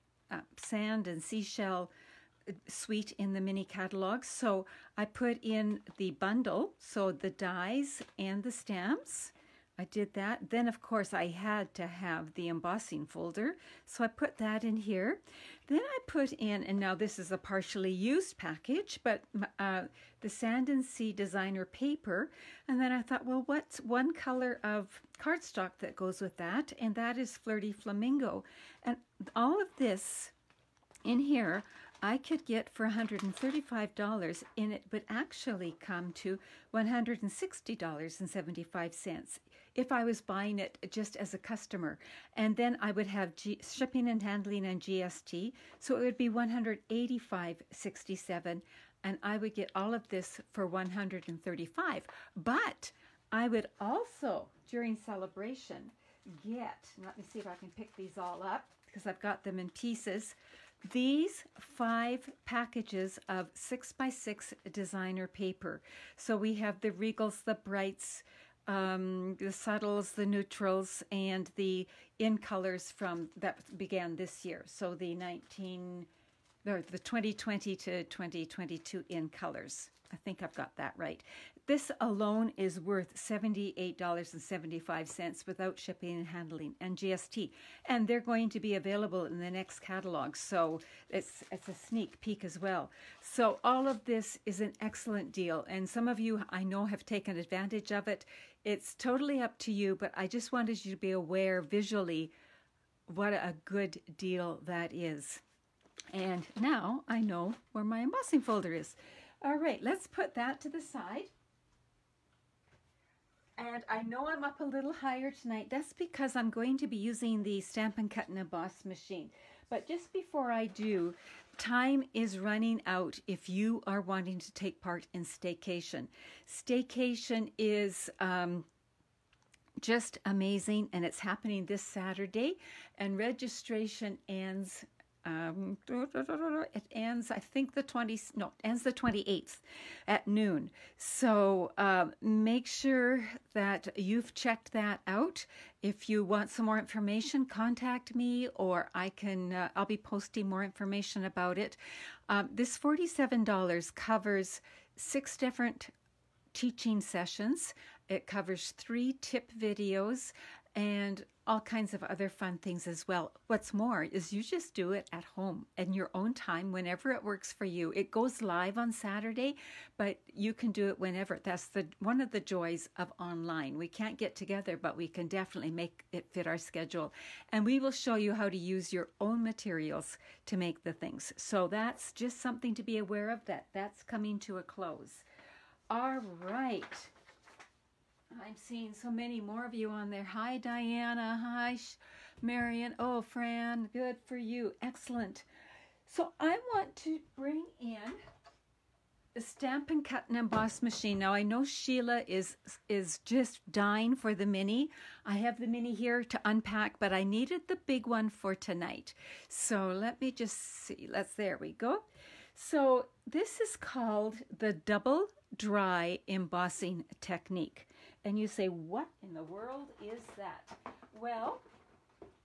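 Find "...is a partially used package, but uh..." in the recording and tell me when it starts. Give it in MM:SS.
00:17.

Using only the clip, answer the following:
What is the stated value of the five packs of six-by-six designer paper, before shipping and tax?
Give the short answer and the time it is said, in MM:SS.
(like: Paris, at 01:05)
$78.75, at 01:23.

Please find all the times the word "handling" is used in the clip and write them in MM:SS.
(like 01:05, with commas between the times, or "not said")
00:44, 01:26.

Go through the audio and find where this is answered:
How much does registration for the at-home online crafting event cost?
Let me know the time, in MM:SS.
02:32.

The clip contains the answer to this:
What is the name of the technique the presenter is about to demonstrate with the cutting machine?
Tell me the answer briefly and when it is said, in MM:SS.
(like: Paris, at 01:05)
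double dry embossing, at 03:34.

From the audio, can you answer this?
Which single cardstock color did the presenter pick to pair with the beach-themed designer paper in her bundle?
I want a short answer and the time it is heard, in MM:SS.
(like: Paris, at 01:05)
Flirty Flamingo, at 00:27.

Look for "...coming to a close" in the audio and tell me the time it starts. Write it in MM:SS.
03:04.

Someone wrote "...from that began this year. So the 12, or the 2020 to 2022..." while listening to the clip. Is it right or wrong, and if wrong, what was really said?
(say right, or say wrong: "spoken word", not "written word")
wrong: "19", not "12".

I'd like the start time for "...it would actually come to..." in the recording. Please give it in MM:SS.
00:34.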